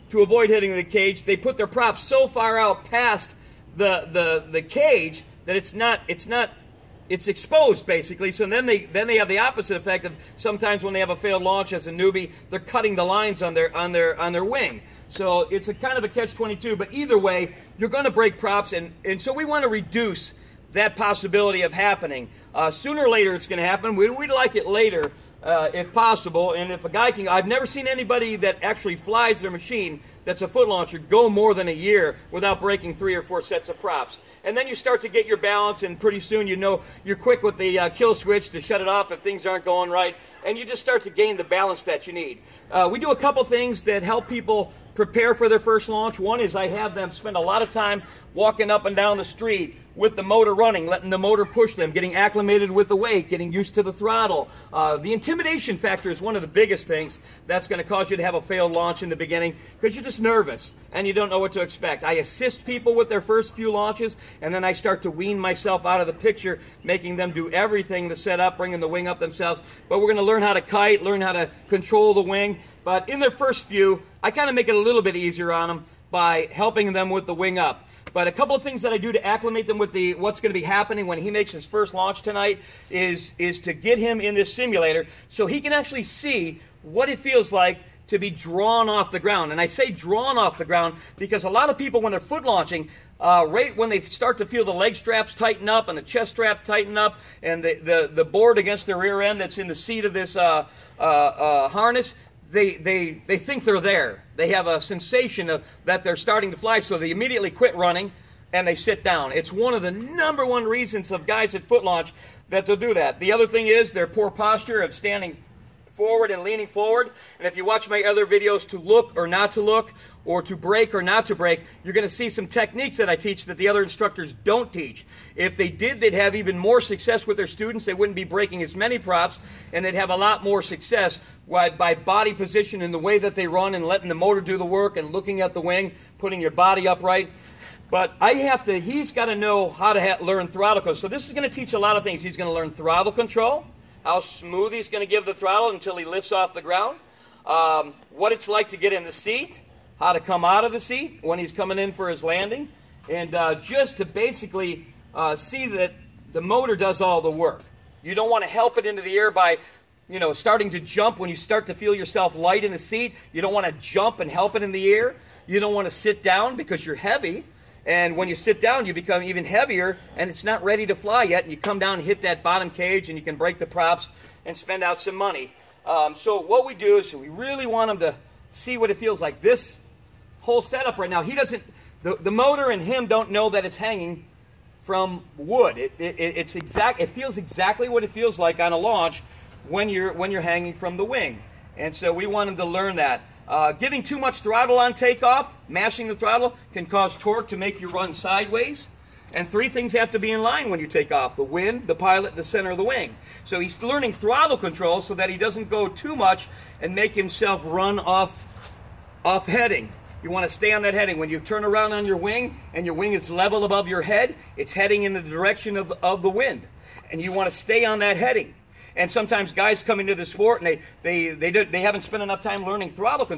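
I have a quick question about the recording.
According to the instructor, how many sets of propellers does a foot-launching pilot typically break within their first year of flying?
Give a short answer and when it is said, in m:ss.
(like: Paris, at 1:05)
3 or 4, at 0:32.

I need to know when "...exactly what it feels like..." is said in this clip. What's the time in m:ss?
3:07.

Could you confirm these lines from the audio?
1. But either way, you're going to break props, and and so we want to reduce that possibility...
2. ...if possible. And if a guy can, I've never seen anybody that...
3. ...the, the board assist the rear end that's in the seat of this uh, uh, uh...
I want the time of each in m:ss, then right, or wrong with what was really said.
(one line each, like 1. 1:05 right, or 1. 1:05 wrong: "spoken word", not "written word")
1. 0:16 right
2. 0:25 right
3. 1:37 wrong: "against", not "assist".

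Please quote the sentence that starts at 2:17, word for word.
But I have to, he's got to know how to learn throttle control.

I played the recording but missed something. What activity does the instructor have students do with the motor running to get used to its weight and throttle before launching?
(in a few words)
Walking up and down the street.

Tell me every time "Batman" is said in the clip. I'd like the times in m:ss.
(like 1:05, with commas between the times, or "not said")
not said.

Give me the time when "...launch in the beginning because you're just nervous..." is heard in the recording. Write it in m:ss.
0:58.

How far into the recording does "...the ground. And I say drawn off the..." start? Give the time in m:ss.
1:29.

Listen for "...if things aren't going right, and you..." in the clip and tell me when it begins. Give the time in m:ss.
0:39.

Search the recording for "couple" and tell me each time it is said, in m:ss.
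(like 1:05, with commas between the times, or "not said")
0:43, 1:18.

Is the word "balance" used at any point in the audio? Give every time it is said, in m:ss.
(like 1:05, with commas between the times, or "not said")
0:35, 0:41.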